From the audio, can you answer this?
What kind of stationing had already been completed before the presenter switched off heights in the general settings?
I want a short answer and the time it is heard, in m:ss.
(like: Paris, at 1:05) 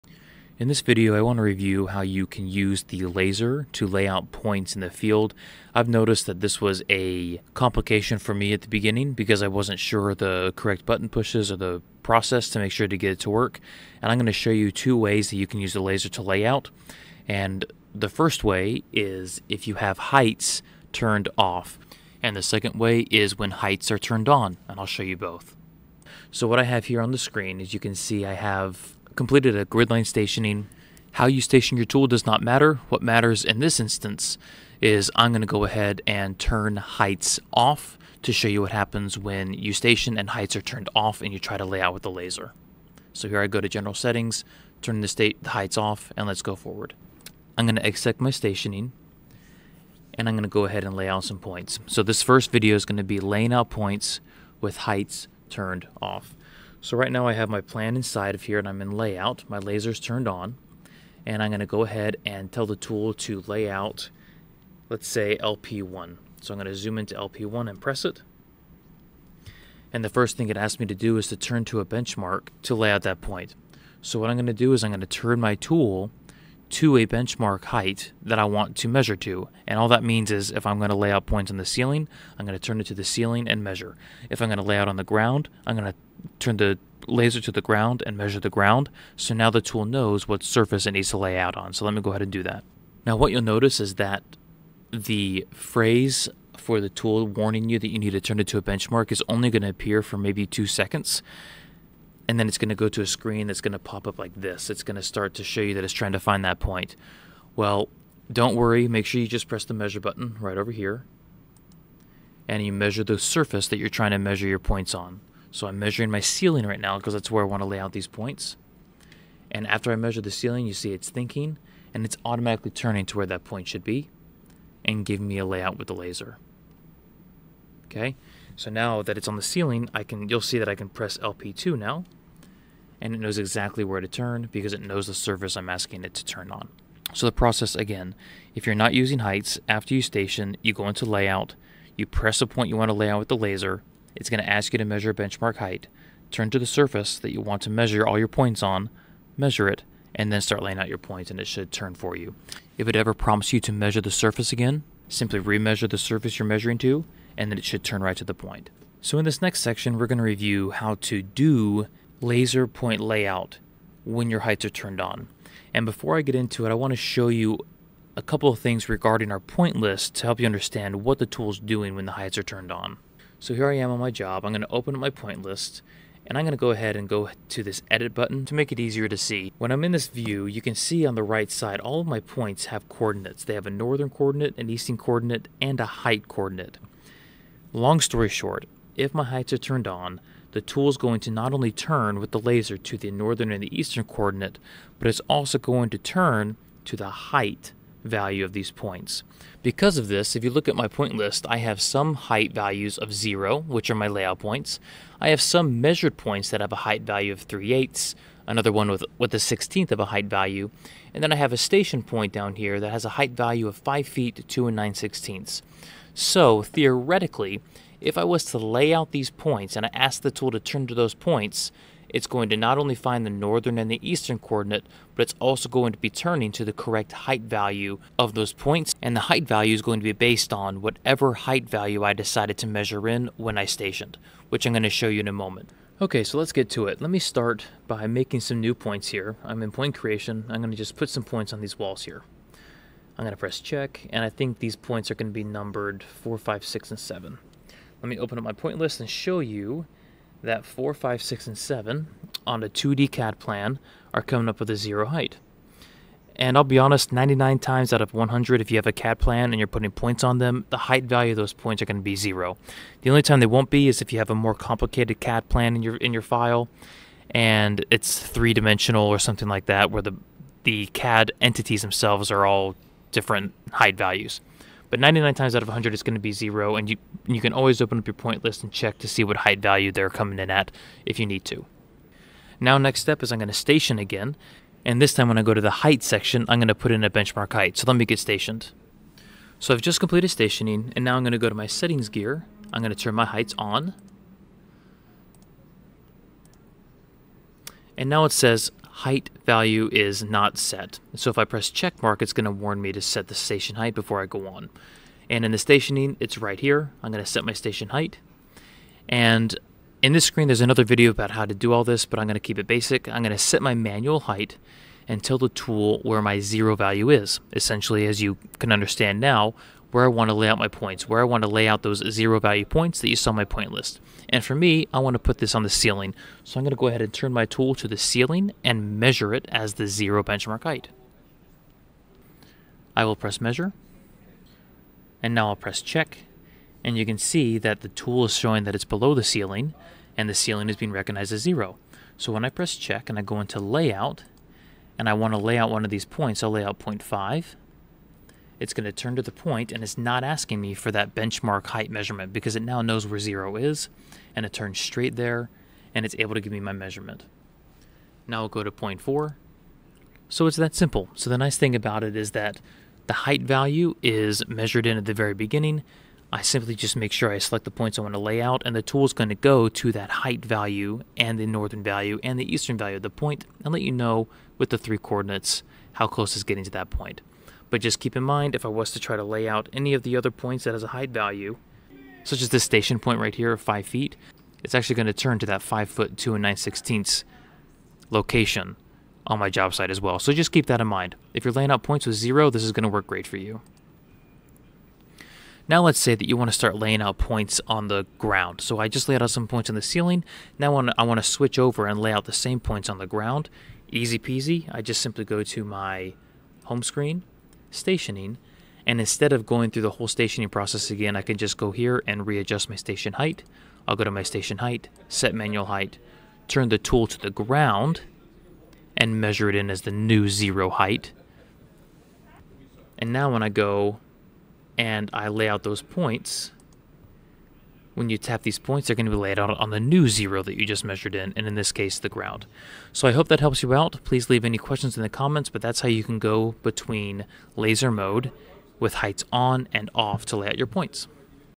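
Gridline stationing, at 0:29.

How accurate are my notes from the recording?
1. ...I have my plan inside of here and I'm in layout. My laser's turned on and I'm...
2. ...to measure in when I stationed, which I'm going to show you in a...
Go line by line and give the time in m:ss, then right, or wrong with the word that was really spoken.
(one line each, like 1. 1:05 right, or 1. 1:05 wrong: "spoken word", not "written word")
1. 0:57 right
2. 3:52 right.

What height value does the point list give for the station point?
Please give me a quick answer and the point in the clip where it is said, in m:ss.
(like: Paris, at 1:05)
5 feet 2 and 9/16, at 3:33.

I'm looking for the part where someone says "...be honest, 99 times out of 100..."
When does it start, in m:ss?
4:16.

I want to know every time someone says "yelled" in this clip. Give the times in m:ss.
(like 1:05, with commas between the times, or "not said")
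not said.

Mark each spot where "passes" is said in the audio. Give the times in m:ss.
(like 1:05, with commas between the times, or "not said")
not said.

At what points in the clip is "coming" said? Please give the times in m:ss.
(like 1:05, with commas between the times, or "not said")
4:14, 4:40.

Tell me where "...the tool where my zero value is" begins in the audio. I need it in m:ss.
5:15.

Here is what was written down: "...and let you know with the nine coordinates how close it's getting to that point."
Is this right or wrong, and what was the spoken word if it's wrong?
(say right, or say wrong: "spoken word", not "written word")
wrong: "three", not "nine".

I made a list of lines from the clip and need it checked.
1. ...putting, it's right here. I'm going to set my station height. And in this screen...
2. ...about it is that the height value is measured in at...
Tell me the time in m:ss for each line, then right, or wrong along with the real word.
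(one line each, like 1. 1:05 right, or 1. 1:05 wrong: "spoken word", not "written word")
1. 5:05 wrong: "stationing", not "putting"
2. 6:01 right.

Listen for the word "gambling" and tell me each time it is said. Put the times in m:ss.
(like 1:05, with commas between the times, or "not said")
not said.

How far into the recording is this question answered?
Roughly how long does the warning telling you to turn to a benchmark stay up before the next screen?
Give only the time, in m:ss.
1:40.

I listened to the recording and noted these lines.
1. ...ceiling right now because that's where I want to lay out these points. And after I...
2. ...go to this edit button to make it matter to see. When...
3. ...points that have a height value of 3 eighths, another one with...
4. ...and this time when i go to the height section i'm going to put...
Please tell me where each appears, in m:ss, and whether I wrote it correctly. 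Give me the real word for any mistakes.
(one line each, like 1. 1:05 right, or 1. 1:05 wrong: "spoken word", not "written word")
1. 1:56 right
2. 2:57 wrong: "easier", not "matter"
3. 3:26 right
4. 4:44 right.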